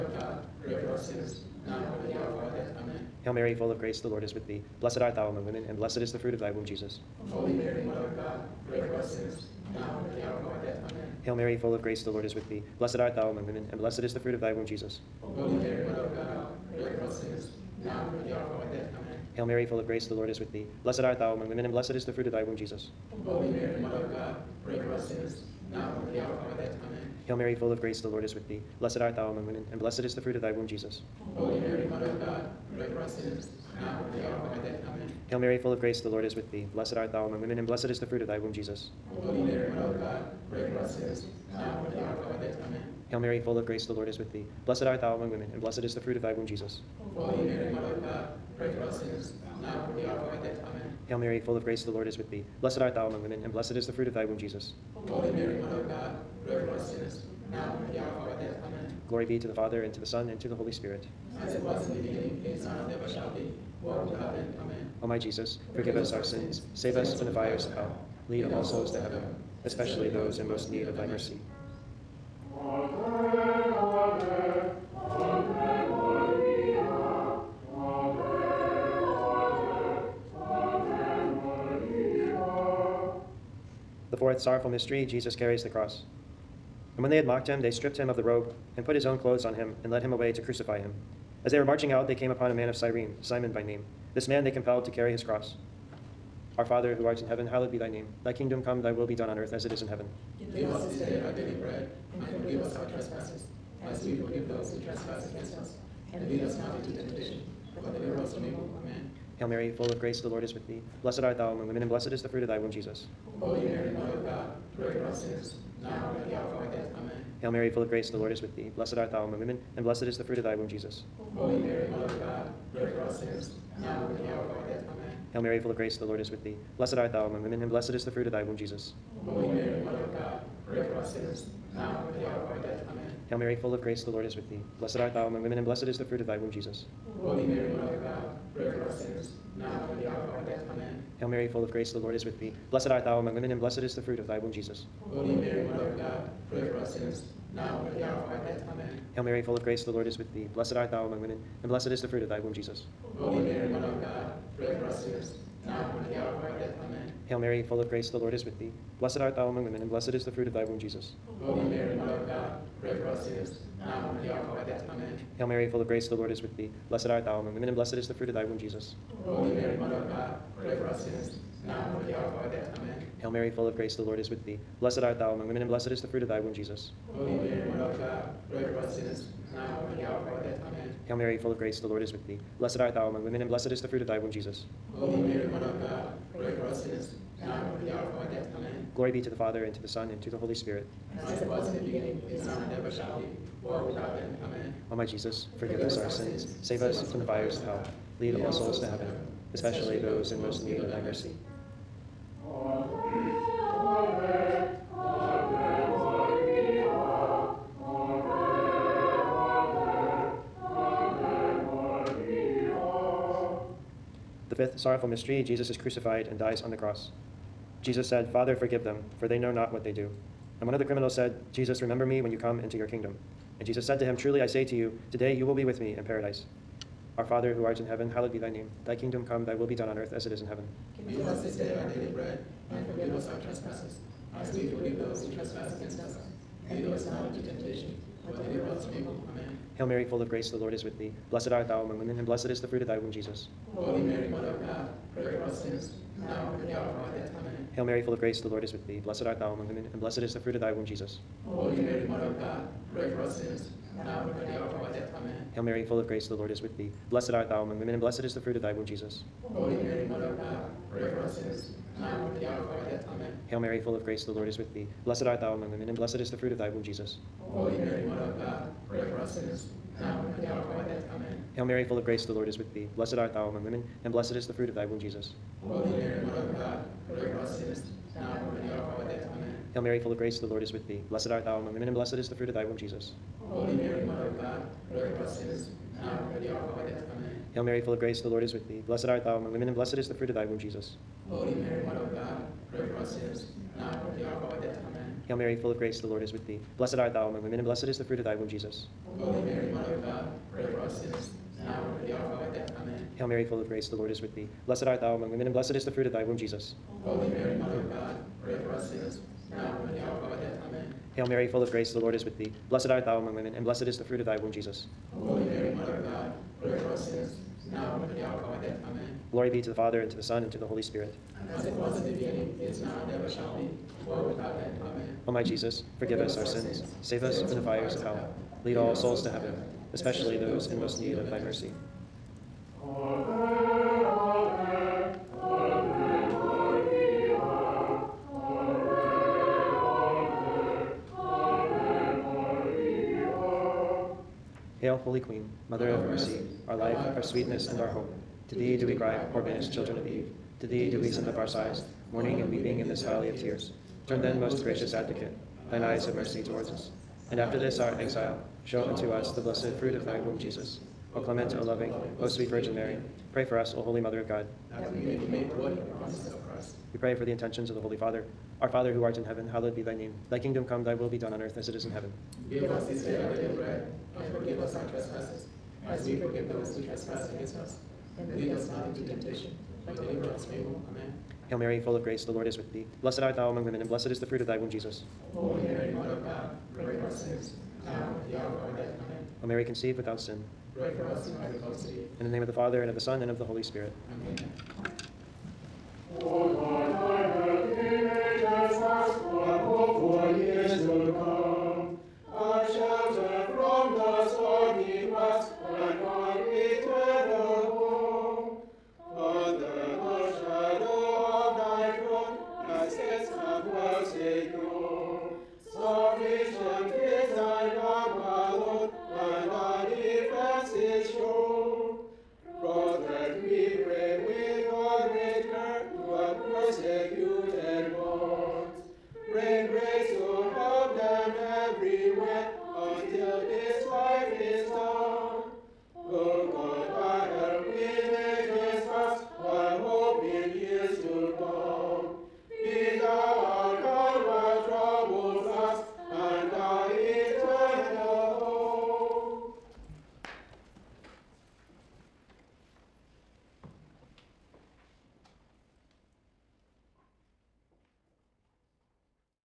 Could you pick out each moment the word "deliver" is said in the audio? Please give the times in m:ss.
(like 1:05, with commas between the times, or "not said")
1:47, 3:58, 6:19.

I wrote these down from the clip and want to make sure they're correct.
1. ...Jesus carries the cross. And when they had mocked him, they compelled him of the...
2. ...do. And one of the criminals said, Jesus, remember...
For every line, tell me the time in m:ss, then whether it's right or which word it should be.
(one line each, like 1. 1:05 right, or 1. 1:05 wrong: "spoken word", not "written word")
1. 1:25 wrong: "stripped", not "compelled"
2. 3:39 right.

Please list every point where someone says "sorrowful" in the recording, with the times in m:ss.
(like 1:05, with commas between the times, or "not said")
1:24, 3:34.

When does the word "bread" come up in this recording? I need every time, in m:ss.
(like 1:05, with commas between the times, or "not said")
1:41, 3:52, 6:13.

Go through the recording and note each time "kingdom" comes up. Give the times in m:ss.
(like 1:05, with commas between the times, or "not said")
1:38, 3:42, 3:48, 6:10.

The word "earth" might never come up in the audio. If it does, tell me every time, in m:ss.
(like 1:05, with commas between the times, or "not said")
1:39, 3:49, 6:11.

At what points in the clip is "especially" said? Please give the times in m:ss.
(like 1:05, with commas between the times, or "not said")
1:09, 3:19, 5:29.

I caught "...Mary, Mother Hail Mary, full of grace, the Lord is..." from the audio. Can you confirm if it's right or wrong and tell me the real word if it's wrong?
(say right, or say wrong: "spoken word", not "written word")
right.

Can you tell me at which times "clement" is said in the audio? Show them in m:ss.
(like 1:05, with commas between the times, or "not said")
6:01.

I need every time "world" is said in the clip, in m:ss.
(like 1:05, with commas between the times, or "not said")
1:03, 3:13, 5:24.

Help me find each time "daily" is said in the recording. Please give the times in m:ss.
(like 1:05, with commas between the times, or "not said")
1:41, 3:51, 6:13.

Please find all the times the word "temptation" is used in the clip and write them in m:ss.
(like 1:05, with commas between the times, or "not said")
1:46, 3:57, 6:19.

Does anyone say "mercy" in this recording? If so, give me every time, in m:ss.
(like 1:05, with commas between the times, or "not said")
1:11, 3:21, 5:31, 5:46, 5:56.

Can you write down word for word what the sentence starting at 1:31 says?
As they were marching out, they came upon a man of Cyrene, Simon by name.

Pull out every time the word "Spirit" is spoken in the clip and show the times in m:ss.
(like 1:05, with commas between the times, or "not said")
1:00, 3:10, 5:20, 6:33.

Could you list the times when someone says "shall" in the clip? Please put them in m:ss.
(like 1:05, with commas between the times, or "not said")
1:03, 3:12, 5:23.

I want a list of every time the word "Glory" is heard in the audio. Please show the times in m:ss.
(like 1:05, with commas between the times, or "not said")
0:59, 3:08, 5:19.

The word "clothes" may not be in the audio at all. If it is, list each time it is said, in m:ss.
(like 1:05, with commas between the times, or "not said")
1:29.